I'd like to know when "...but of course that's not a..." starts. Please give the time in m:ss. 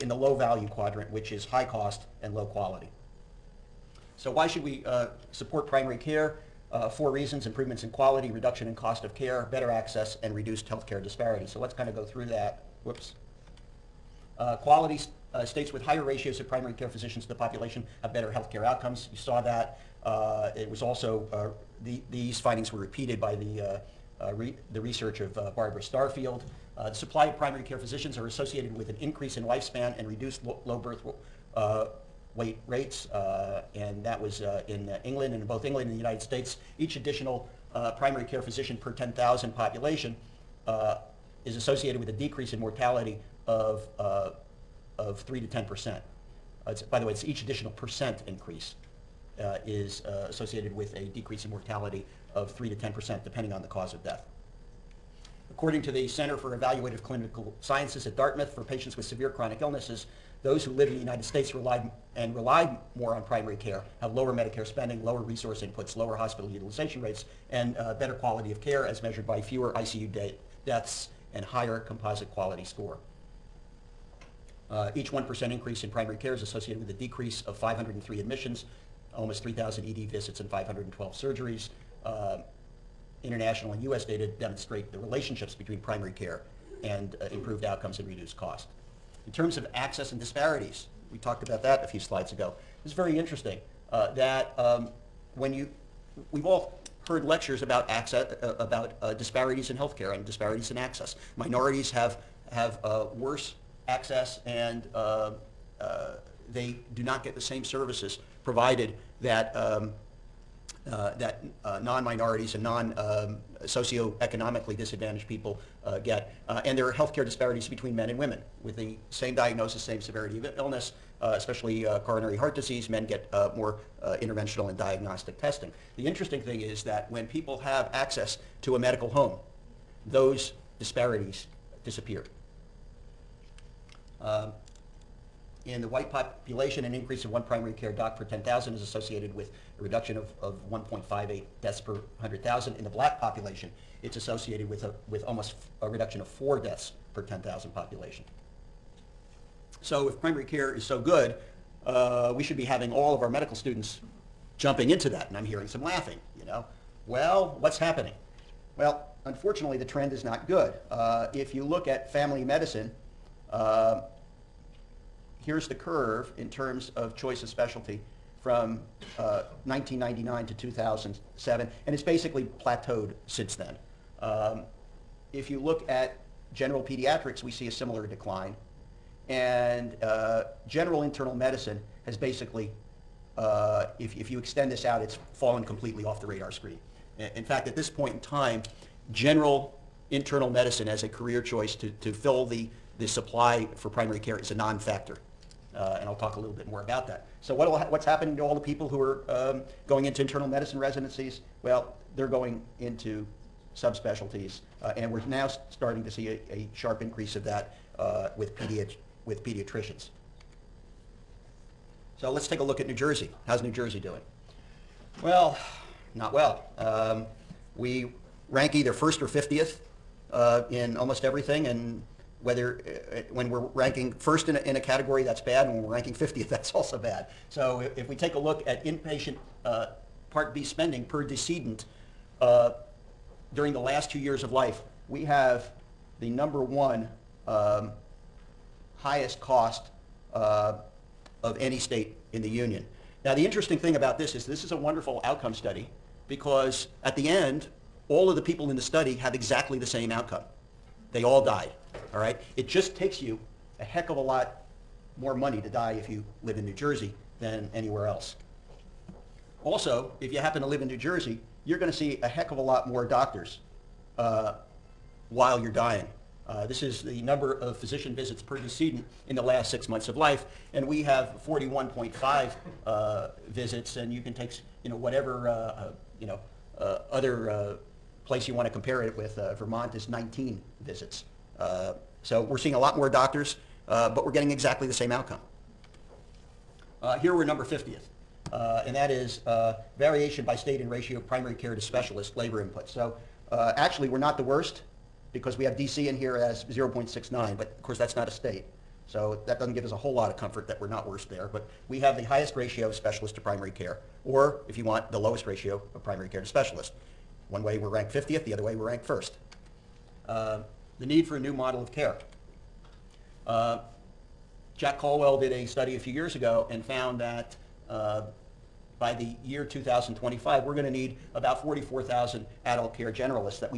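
4:57.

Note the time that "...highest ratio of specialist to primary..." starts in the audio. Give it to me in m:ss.
5:02.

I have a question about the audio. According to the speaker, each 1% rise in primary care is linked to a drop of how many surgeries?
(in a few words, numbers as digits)
512.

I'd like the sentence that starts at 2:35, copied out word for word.
And I'm hearing some laughing, you know.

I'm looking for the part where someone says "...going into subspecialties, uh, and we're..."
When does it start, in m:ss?
3:22.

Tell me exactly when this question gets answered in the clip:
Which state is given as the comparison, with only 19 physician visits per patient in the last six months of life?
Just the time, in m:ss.
4:39.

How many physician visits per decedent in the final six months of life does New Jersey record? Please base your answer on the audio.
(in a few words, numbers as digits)
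41.5.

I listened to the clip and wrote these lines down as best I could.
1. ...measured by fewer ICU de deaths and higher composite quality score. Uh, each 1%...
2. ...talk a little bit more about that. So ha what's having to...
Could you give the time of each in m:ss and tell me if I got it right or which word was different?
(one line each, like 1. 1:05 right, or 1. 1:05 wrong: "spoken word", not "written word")
1. 1:09 right
2. 3:16 wrong: "happening", not "having".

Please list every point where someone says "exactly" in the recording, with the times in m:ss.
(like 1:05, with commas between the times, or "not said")
4:09, 4:44.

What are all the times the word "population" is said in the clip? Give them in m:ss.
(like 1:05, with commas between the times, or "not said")
0:17, 0:39, 2:16, 2:23, 2:27.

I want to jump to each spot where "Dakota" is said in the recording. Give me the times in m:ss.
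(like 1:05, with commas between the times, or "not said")
not said.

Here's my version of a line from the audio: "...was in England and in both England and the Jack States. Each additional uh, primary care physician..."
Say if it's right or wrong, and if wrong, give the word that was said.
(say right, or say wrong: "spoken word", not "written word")
wrong: "United", not "Jack".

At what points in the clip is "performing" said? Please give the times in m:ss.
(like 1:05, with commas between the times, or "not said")
not said.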